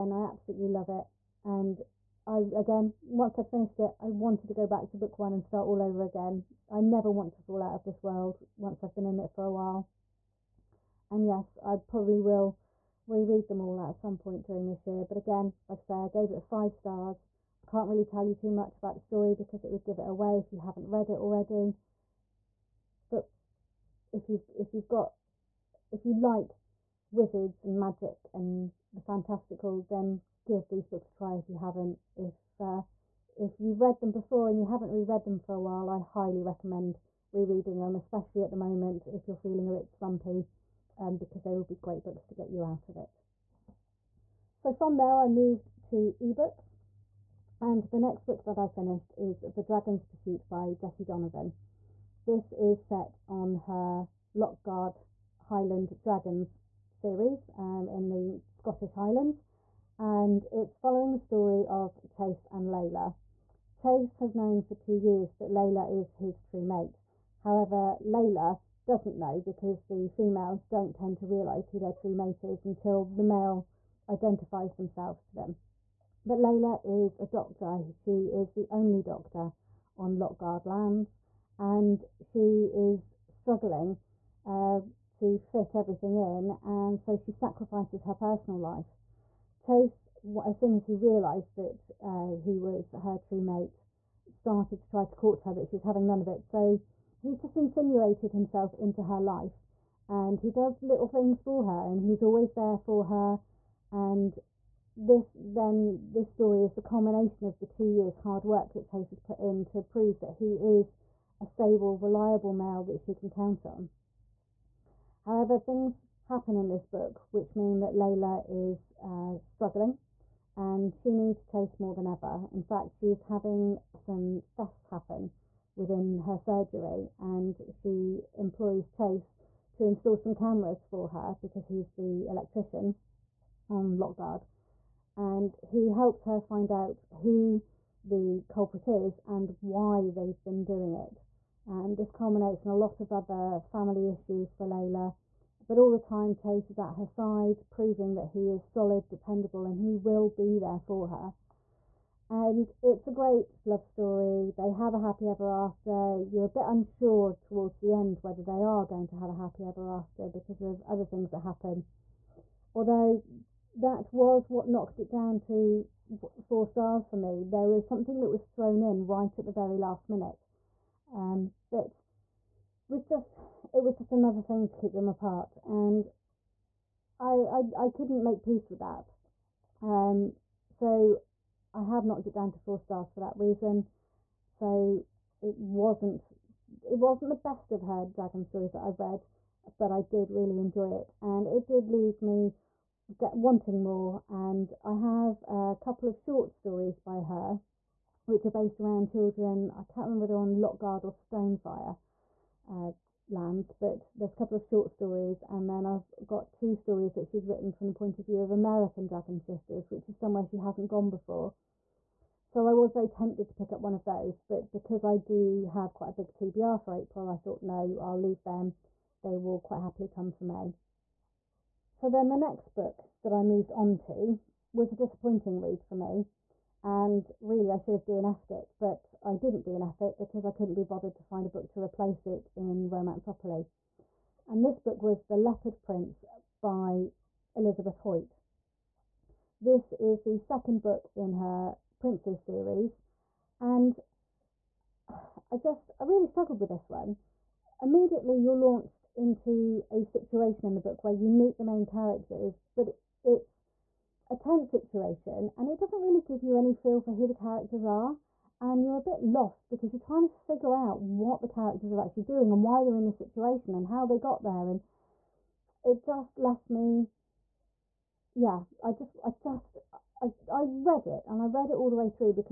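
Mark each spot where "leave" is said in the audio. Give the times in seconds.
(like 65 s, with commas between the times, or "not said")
191 s, 218 s.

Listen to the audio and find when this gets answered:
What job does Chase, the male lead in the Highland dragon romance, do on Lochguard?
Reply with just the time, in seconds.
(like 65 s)
132 s.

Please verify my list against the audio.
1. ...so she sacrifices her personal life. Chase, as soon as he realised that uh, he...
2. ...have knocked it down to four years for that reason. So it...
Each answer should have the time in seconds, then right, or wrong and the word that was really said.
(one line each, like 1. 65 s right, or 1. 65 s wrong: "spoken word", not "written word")
1. 86 s right
2. 181 s wrong: "stars", not "years".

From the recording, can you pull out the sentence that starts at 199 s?
I can't remember whether on Lochguard or Stonefire.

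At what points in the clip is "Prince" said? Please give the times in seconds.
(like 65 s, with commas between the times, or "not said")
235 s, 242 s.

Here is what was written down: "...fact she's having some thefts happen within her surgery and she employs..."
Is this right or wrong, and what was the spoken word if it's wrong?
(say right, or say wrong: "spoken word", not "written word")
right.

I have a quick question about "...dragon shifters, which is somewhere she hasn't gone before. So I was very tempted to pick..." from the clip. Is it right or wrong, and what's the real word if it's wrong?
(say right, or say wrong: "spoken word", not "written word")
right.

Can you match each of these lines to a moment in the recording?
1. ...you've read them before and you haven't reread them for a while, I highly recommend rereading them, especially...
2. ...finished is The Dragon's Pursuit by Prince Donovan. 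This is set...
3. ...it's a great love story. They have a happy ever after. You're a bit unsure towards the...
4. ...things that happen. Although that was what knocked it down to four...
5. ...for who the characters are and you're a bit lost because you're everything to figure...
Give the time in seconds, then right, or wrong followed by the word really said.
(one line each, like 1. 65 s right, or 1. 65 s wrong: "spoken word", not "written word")
1. 33 s right
2. 48 s wrong: "Jessie", not "Prince"
3. 152 s right
4. 161 s right
5. 257 s wrong: "trying", not "everything".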